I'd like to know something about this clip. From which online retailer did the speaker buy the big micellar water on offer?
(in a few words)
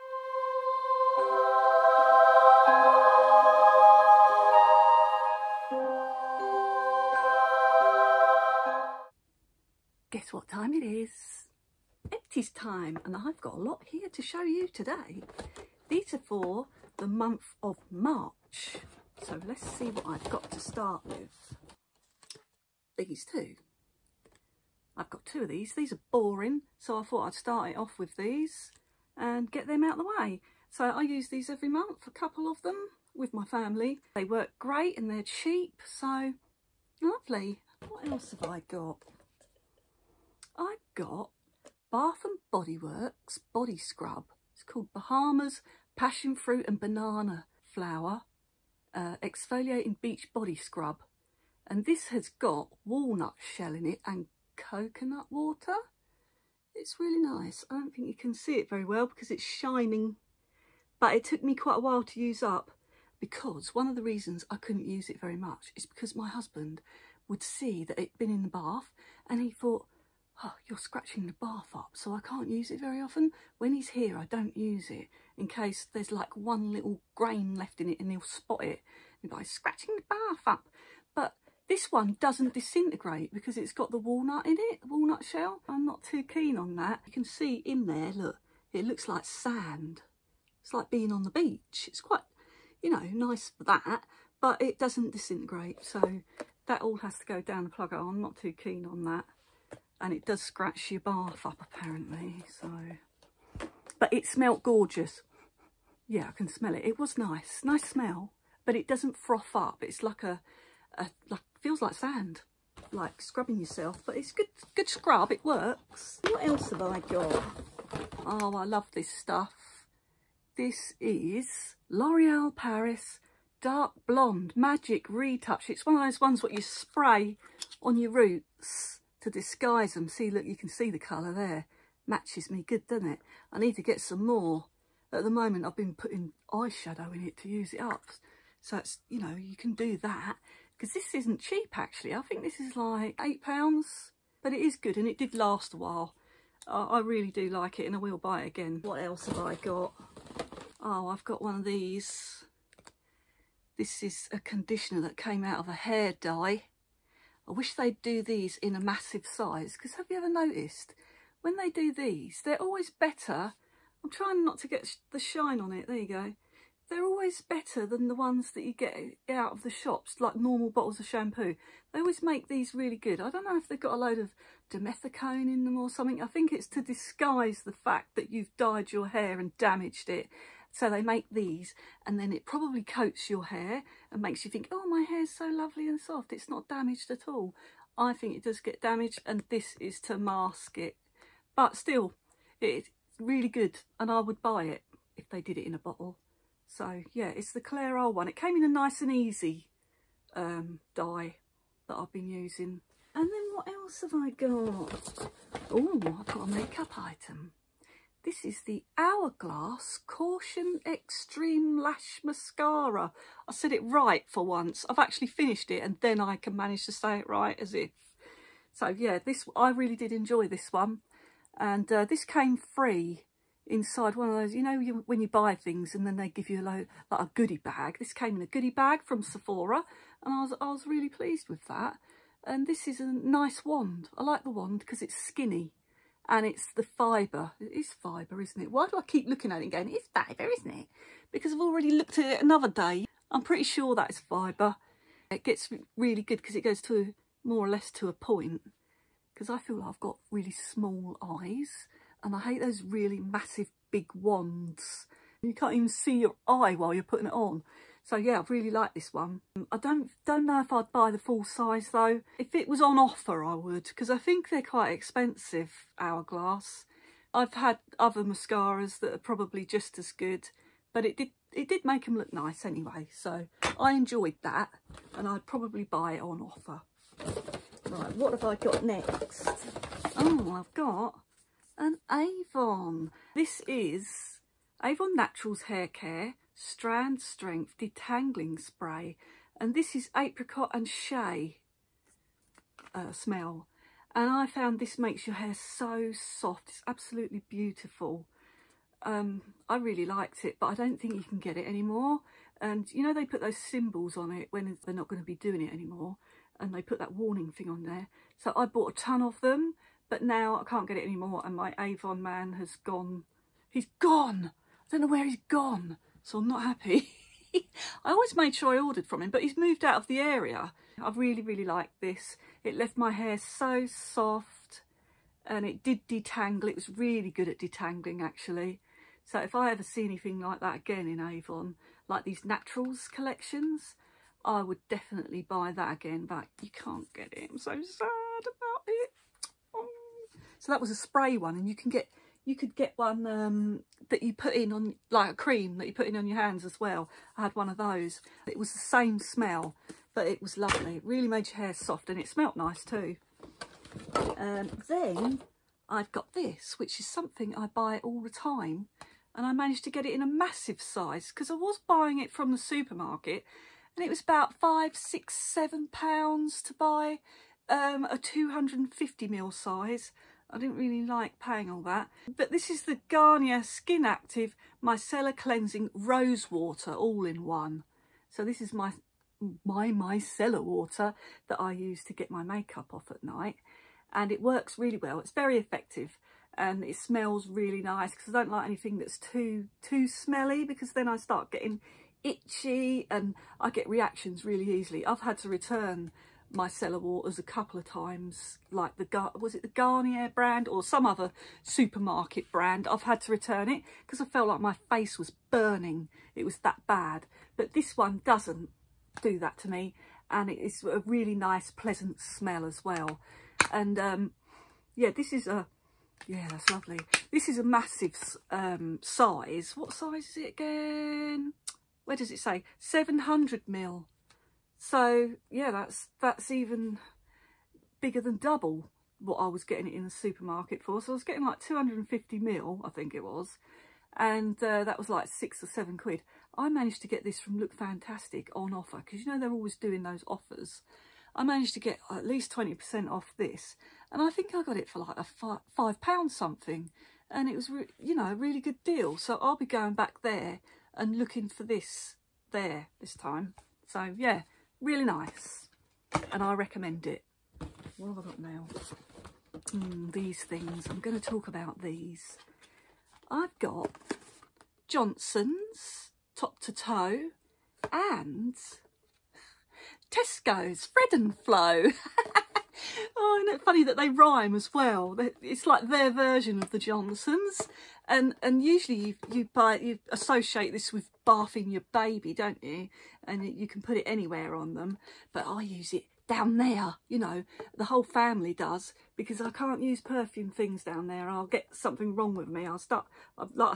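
Look Fantastic.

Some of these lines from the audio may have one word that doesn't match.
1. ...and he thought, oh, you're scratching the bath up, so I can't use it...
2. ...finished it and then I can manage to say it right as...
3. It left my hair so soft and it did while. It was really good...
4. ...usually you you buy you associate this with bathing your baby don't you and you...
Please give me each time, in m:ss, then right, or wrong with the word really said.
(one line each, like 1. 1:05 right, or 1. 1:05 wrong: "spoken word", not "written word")
1. 1:09 right
2. 3:35 right
3. 5:22 wrong: "detangle", not "while"
4. 7:58 right.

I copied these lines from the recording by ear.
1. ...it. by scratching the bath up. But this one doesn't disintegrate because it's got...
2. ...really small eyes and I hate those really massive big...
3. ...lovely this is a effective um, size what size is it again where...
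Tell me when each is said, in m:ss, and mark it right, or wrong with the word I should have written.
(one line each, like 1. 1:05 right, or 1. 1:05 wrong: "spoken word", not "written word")
1. 1:18 right
2. 4:10 right
3. 6:56 wrong: "massive", not "effective".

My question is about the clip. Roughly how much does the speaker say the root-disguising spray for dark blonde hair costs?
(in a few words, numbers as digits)
£8.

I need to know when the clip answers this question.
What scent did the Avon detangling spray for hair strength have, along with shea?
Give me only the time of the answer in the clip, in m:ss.
4:50.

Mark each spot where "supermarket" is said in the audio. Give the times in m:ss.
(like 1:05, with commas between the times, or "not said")
6:02, 6:41, 7:10.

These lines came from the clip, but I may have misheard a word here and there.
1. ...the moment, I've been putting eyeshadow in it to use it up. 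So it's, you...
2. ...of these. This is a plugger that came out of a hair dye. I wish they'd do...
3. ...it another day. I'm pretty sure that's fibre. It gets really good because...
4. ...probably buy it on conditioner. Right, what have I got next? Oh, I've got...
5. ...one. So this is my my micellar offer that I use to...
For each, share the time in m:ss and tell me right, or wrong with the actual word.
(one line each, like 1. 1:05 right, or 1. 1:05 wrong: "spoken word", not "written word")
1. 2:15 right
2. 2:31 wrong: "conditioner", not "plugger"
3. 4:02 right
4. 4:35 wrong: "offer", not "conditioner"
5. 6:17 wrong: "water", not "offer".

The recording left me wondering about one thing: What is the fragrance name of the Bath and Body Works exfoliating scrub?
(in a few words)
Bahamas Passion Fruit and Banana Flower.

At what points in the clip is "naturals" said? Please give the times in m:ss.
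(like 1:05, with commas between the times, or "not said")
4:45, 5:32.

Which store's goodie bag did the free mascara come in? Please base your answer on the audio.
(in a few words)
Sephora.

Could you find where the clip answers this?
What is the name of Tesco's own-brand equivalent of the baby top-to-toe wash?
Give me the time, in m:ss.
7:50.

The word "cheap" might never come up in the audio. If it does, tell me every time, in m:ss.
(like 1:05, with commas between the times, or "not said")
0:35, 2:21.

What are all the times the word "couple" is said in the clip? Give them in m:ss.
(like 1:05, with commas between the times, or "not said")
0:32, 6:37.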